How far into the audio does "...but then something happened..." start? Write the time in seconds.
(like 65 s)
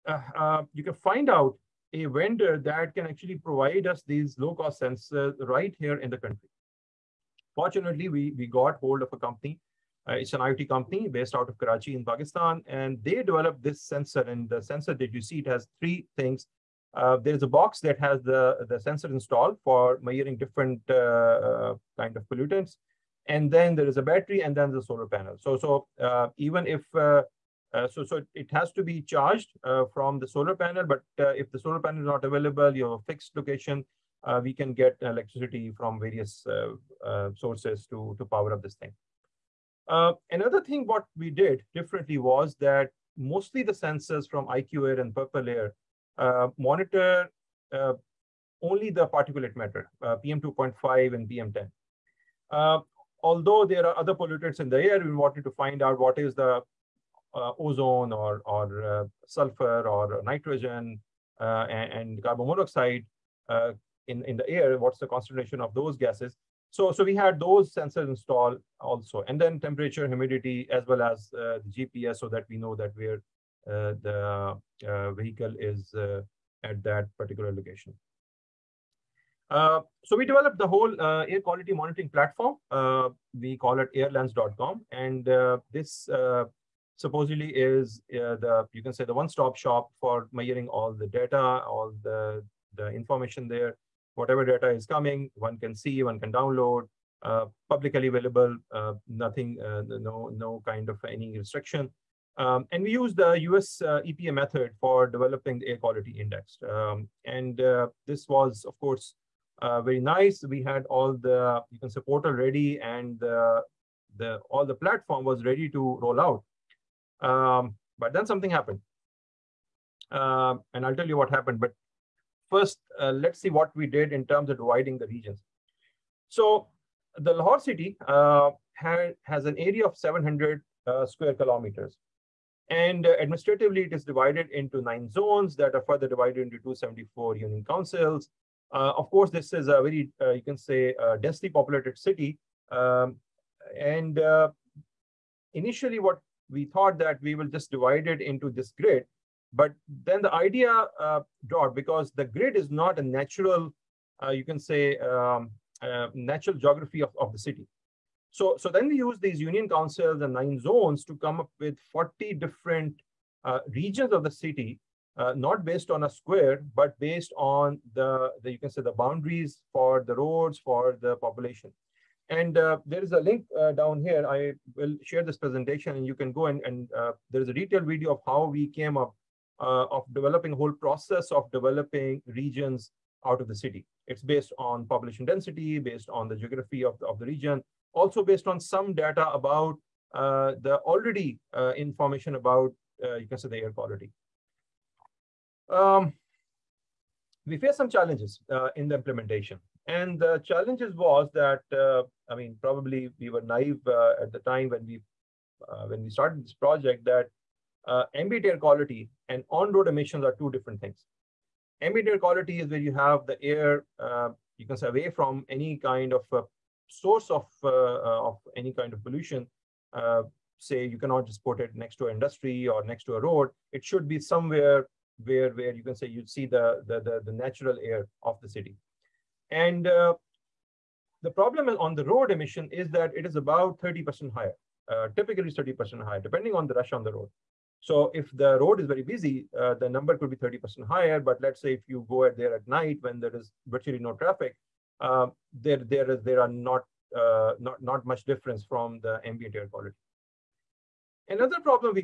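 117 s.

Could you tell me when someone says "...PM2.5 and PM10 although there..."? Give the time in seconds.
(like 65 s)
50 s.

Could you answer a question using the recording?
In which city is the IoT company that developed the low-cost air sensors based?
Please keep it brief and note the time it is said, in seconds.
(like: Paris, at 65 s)
Karachi, at 11 s.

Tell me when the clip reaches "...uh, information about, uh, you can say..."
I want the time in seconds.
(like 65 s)
191 s.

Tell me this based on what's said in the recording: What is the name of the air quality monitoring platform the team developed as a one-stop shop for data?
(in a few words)
airlands.com.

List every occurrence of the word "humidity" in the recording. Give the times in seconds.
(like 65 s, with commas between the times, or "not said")
70 s.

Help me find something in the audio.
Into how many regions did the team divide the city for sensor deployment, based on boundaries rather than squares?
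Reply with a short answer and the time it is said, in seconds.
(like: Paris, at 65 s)
40, at 161 s.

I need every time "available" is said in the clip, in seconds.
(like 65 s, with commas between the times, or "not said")
32 s, 98 s.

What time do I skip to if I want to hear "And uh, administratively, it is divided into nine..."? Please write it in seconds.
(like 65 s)
132 s.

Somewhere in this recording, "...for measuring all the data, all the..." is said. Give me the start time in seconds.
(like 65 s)
90 s.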